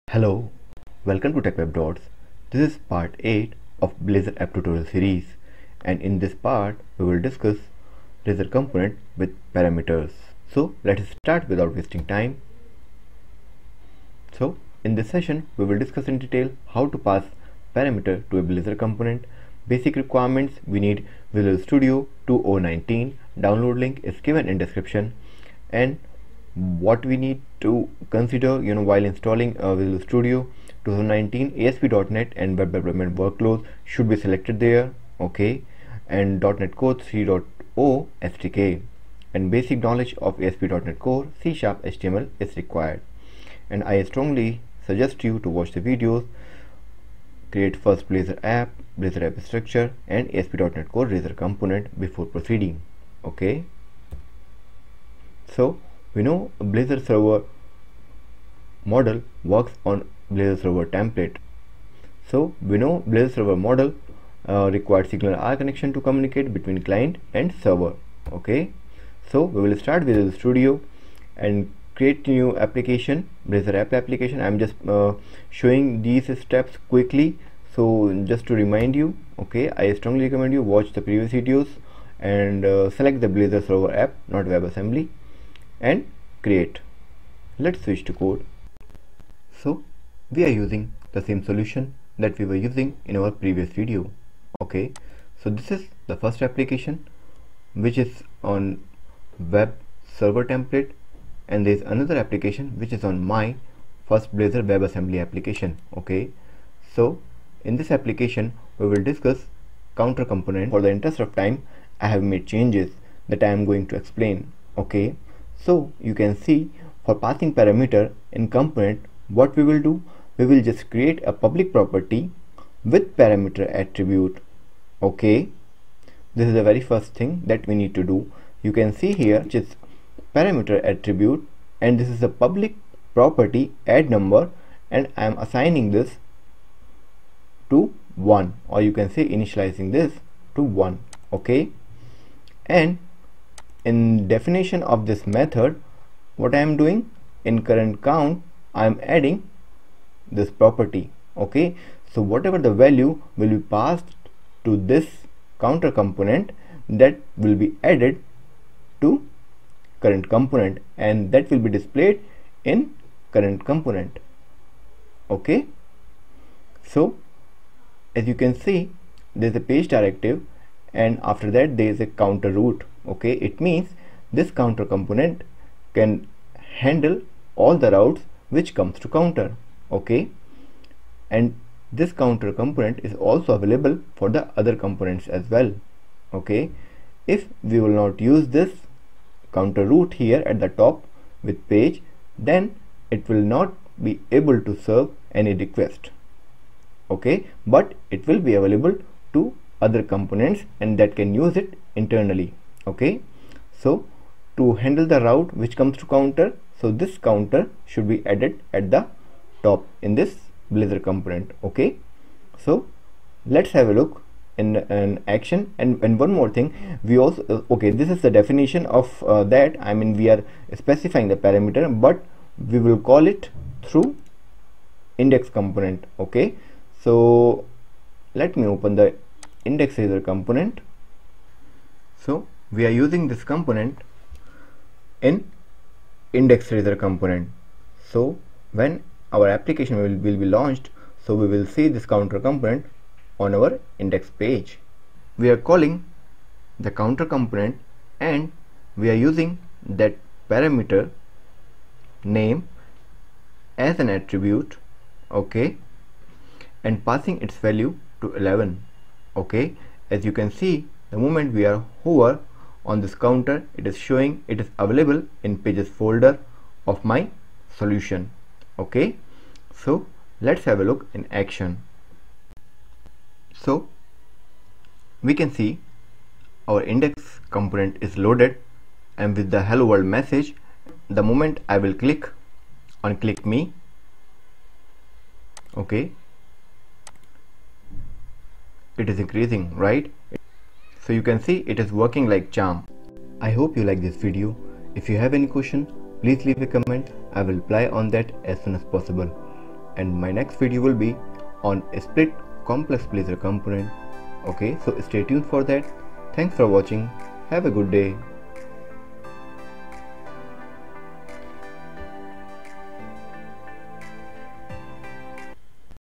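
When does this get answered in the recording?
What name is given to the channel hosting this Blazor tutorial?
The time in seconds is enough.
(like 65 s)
1 s.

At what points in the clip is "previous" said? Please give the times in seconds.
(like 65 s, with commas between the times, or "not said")
81 s, 93 s.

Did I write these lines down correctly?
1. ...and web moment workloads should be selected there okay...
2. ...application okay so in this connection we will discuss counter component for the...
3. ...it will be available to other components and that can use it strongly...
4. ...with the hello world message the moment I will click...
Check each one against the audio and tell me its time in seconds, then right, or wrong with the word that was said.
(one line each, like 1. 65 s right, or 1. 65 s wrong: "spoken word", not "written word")
1. 32 s wrong: "development", not "moment"
2. 105 s wrong: "application", not "connection"
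3. 198 s wrong: "internally", not "strongly"
4. 279 s right.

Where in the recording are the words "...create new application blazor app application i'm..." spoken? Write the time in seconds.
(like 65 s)
71 s.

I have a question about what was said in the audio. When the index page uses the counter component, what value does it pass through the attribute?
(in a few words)
11.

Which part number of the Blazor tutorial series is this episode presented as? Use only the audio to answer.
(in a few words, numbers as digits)
8.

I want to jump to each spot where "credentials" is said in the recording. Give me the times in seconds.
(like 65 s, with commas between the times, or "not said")
not said.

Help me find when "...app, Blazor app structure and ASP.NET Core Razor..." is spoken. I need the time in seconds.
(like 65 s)
48 s.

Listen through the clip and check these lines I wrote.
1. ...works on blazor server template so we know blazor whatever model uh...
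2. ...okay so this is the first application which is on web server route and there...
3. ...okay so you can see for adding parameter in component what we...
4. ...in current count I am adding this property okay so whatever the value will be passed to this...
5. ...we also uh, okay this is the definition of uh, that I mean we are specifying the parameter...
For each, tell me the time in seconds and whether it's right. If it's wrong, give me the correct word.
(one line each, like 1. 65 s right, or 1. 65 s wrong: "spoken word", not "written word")
1. 59 s wrong: "server", not "whatever"
2. 94 s wrong: "template", not "route"
3. 114 s wrong: "passing", not "adding"
4. 147 s right
5. 217 s right.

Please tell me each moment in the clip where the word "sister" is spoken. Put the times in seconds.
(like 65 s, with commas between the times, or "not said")
not said.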